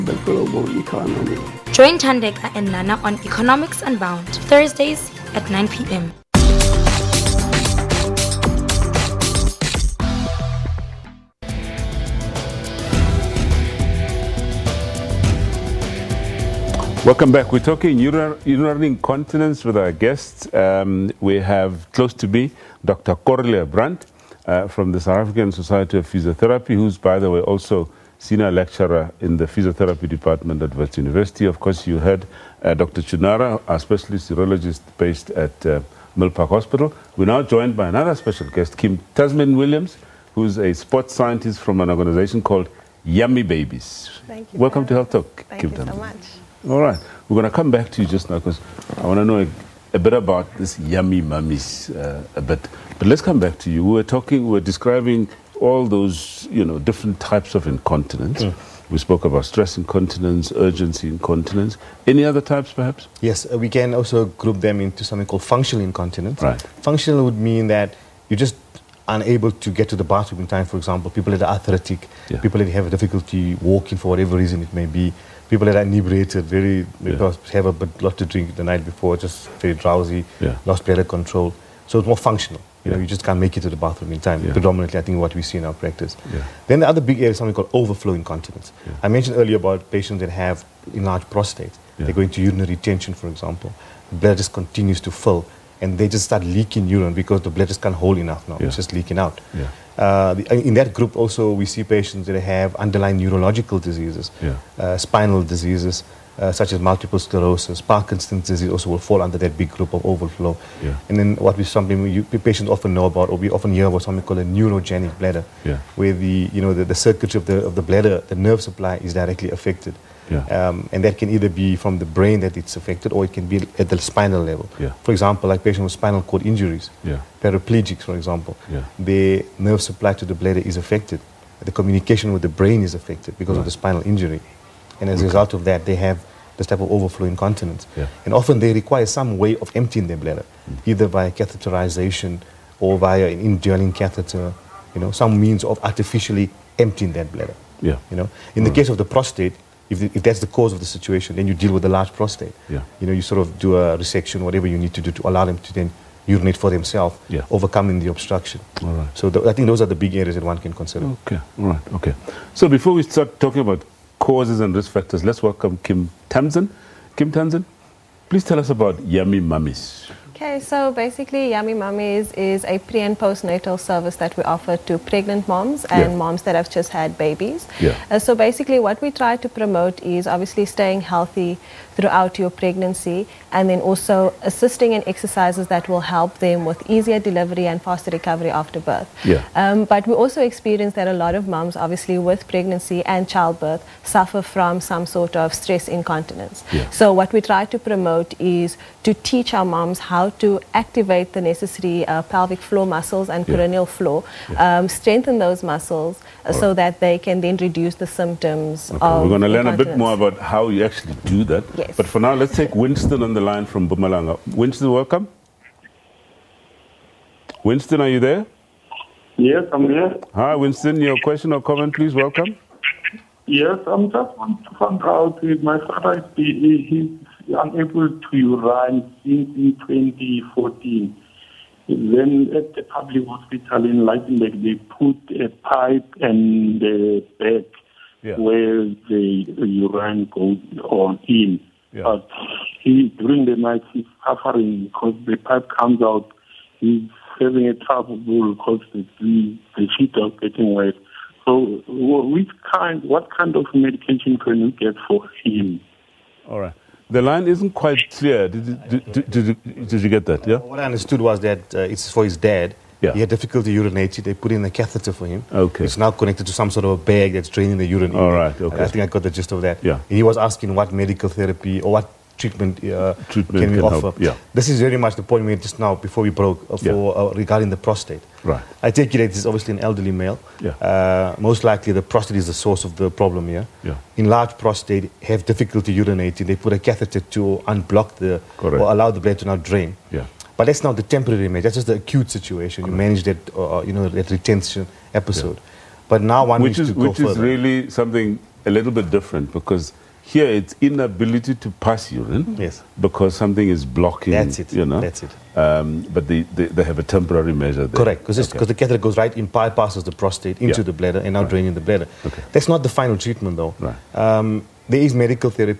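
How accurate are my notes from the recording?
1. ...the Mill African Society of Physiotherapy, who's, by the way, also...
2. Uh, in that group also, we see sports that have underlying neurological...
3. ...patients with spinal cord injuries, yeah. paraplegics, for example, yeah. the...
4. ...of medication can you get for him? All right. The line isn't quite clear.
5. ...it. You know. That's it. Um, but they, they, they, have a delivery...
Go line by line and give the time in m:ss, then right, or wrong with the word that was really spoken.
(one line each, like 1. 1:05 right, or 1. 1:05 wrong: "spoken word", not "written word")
1. 0:24 wrong: "South", not "Mill"
2. 1:39 wrong: "patients", not "sports"
3. 2:05 right
4. 4:13 right
5. 5:04 wrong: "temporary", not "delivery".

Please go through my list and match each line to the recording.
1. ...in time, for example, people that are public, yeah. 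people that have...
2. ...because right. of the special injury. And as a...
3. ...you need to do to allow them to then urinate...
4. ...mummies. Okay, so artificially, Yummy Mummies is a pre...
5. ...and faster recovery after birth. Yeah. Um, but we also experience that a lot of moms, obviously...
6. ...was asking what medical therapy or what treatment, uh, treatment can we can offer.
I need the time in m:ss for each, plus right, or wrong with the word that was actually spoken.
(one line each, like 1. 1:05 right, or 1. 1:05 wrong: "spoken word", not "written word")
1. 1:10 wrong: "athletic", not "public"
2. 2:13 wrong: "spinal", not "special"
3. 2:34 right
4. 2:49 wrong: "basically", not "artificially"
5. 3:07 right
6. 4:30 right.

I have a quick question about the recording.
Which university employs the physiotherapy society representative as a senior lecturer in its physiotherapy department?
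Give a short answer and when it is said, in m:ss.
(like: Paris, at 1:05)
Wits University, at 0:30.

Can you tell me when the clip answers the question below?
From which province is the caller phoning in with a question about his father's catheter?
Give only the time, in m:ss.
3:33.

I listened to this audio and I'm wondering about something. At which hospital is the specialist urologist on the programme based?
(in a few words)
Mill Park Hospital.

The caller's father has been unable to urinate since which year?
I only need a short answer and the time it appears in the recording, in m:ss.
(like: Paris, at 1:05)
2014, at 3:49.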